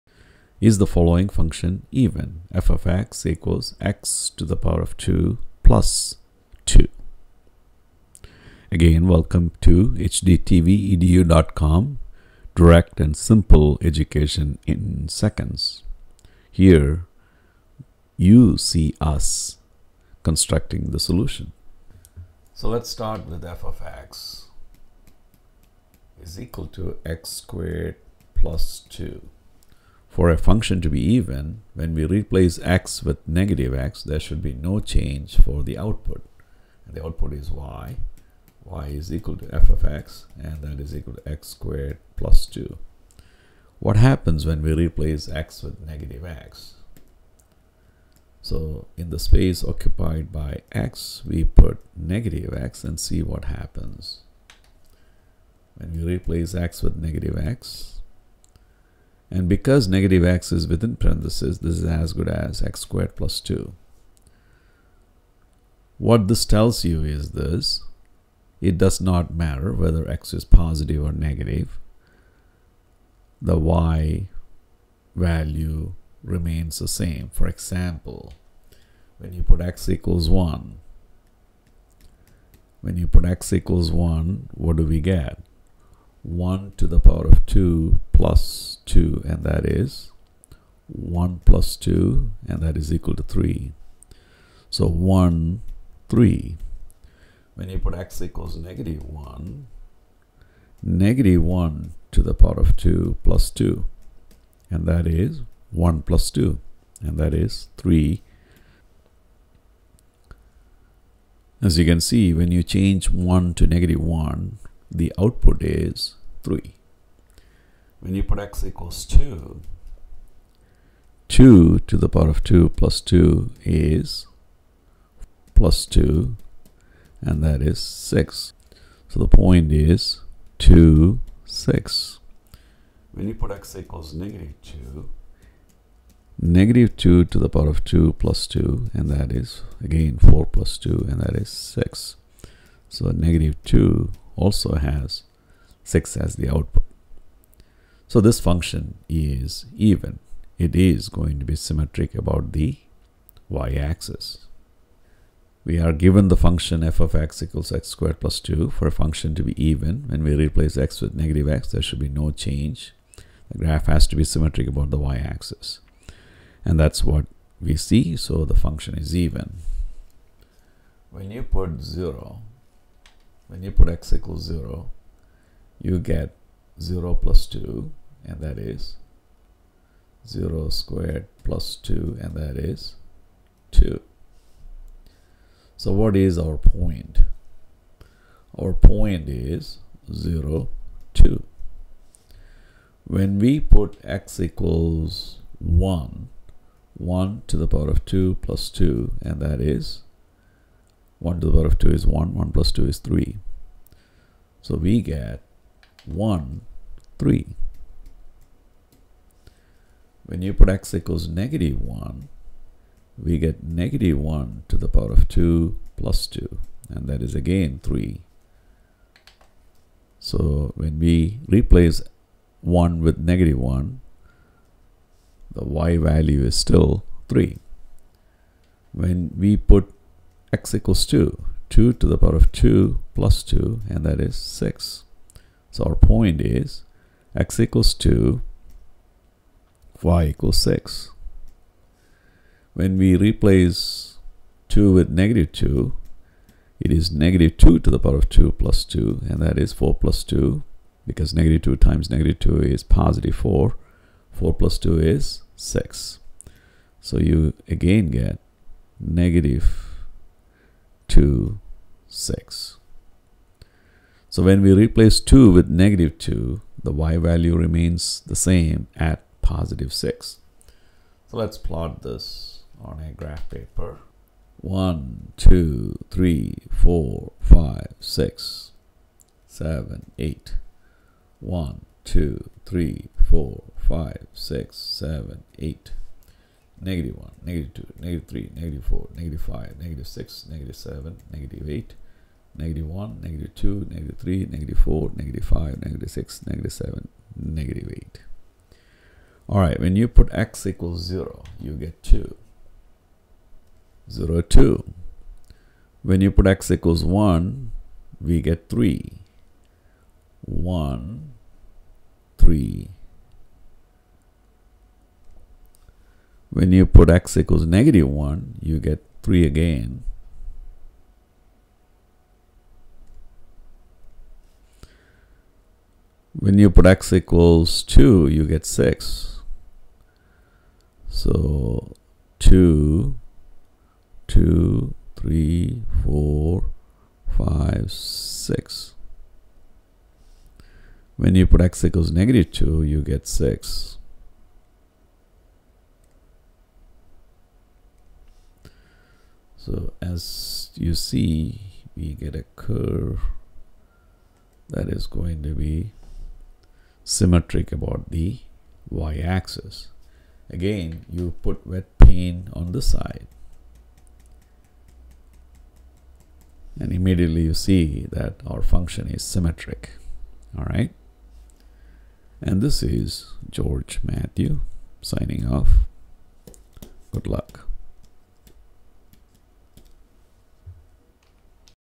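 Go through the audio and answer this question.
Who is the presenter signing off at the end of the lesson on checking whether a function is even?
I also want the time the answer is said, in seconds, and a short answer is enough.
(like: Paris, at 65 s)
George Mathew, at 373 s.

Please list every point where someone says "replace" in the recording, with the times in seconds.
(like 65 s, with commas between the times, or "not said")
32 s, 44 s, 56 s, 160 s, 221 s, 243 s, 264 s.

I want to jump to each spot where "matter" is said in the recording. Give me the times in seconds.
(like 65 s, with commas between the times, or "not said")
69 s.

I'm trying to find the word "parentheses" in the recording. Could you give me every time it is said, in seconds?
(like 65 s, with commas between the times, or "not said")
60 s.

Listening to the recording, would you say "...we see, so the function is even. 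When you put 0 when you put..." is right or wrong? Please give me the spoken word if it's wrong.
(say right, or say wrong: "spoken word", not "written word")
right.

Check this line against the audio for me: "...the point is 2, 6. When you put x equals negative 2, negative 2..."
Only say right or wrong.
right.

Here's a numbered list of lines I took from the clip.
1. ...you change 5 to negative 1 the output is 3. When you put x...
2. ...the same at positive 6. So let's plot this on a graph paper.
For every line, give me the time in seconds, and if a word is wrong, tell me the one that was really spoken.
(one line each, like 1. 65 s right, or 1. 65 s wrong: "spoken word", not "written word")
1. 112 s wrong: "1", not "5"
2. 268 s right.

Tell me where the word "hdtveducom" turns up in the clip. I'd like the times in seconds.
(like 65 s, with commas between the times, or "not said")
9 s.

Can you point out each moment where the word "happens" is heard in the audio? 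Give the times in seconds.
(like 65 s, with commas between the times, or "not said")
43 s, 53 s.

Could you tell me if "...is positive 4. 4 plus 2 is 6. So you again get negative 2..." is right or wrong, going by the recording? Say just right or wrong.
right.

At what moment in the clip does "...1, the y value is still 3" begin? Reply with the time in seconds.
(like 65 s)
223 s.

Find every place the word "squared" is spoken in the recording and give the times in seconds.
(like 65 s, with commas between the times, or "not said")
27 s, 41 s, 62 s, 157 s, 180 s.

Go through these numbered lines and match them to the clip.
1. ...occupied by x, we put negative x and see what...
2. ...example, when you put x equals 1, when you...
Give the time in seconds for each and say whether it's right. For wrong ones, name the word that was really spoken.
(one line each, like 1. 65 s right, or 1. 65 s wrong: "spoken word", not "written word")
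1. 49 s right
2. 77 s right.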